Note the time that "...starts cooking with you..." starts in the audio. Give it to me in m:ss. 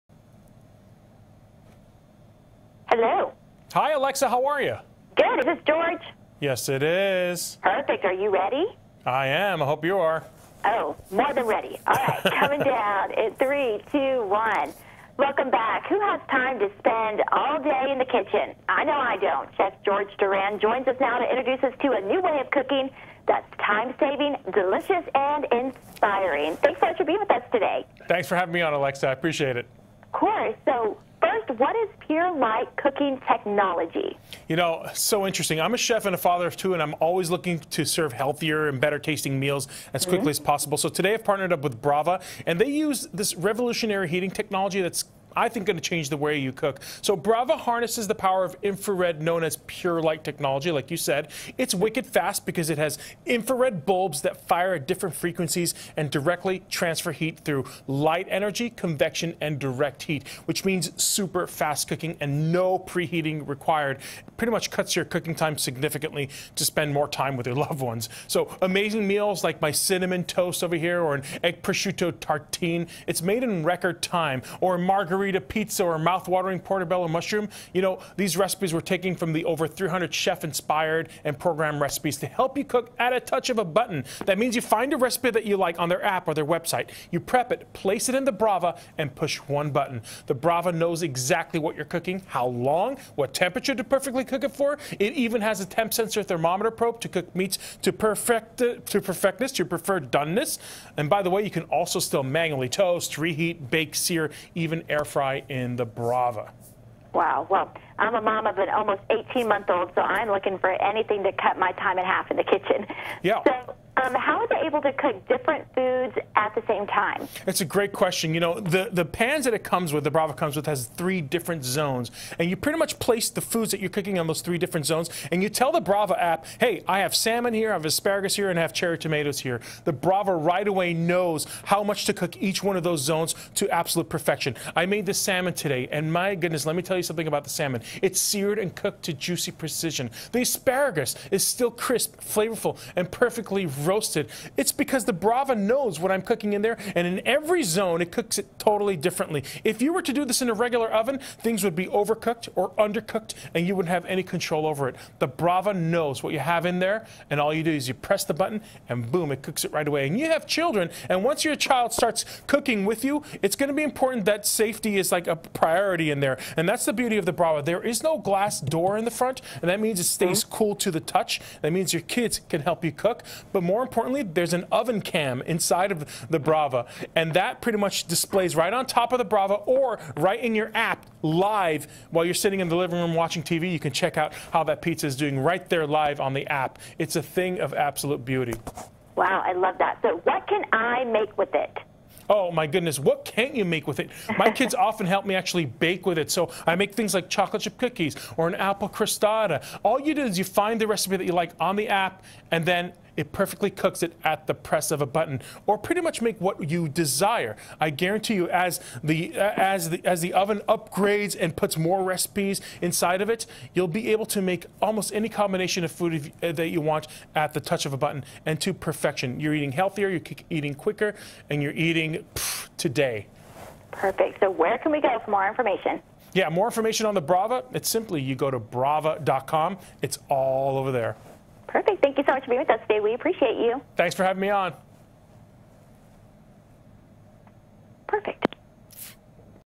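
2:41.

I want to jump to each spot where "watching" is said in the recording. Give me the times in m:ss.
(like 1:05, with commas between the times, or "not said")
3:03.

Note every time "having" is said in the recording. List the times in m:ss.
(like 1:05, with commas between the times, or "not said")
0:28, 3:54.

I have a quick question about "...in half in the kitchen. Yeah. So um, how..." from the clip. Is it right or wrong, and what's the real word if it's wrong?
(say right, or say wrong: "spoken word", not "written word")
right.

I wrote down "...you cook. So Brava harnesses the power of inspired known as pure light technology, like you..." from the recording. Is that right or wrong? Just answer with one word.
wrong.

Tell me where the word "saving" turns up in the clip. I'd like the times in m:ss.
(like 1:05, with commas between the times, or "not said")
0:24.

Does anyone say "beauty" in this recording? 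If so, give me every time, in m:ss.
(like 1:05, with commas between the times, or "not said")
2:46, 3:08.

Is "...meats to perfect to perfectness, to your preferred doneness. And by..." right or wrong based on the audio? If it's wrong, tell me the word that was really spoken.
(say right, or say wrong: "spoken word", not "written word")
right.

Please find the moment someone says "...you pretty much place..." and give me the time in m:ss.
2:02.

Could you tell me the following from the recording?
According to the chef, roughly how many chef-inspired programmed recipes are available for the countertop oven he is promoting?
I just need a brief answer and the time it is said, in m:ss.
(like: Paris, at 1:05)
300, at 1:19.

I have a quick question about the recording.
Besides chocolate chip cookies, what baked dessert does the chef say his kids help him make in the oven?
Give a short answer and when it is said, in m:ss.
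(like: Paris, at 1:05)
Apple crostata, at 3:18.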